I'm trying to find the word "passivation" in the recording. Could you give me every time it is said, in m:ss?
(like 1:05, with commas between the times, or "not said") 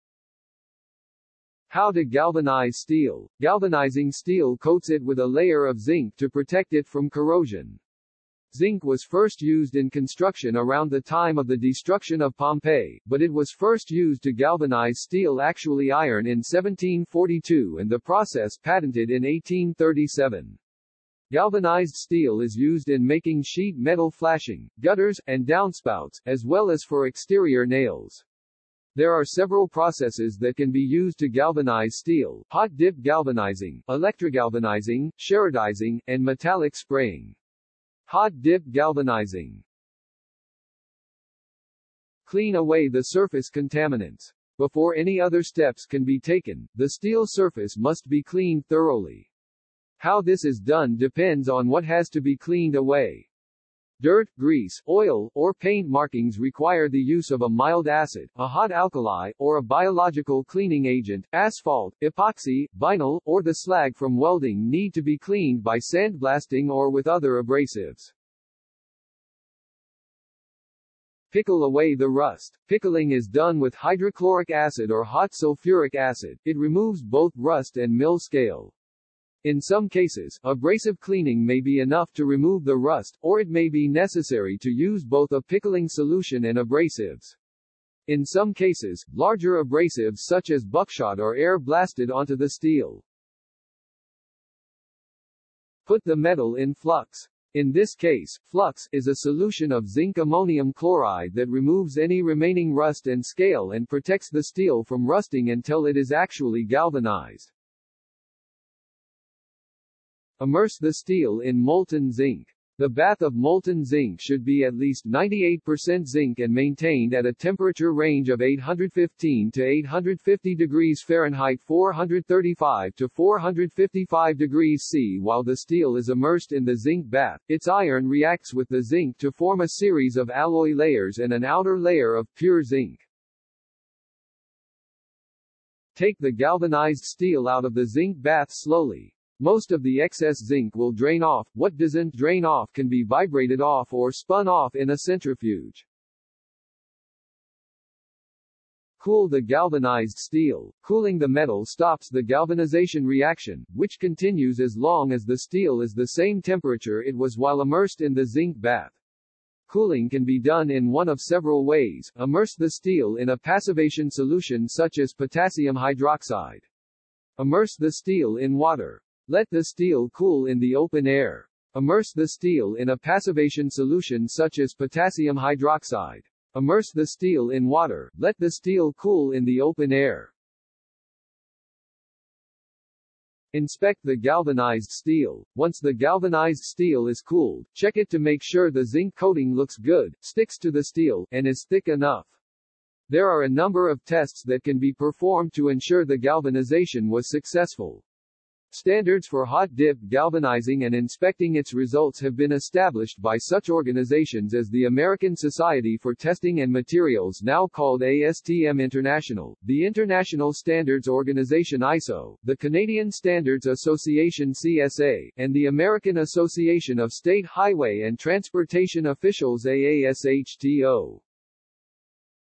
2:43, 2:52.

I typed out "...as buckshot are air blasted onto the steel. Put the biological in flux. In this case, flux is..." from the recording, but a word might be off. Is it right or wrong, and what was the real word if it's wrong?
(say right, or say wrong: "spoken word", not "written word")
wrong: "metal", not "biological".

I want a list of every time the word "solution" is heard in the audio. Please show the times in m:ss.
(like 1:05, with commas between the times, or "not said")
1:25, 1:39, 2:44, 2:53.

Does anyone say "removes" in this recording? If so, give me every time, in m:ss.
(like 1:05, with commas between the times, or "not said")
1:16, 1:22, 1:41.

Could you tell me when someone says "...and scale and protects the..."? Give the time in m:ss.
1:43.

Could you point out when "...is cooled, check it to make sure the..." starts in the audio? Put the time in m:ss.
3:07.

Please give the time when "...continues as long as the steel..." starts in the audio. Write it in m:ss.
2:33.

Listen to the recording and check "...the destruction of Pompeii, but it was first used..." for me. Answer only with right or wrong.
right.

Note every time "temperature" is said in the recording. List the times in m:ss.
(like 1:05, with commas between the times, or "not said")
1:57, 2:36.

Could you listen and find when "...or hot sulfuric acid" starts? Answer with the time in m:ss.
1:14.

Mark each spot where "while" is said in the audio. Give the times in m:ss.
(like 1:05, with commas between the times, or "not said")
2:05, 2:37.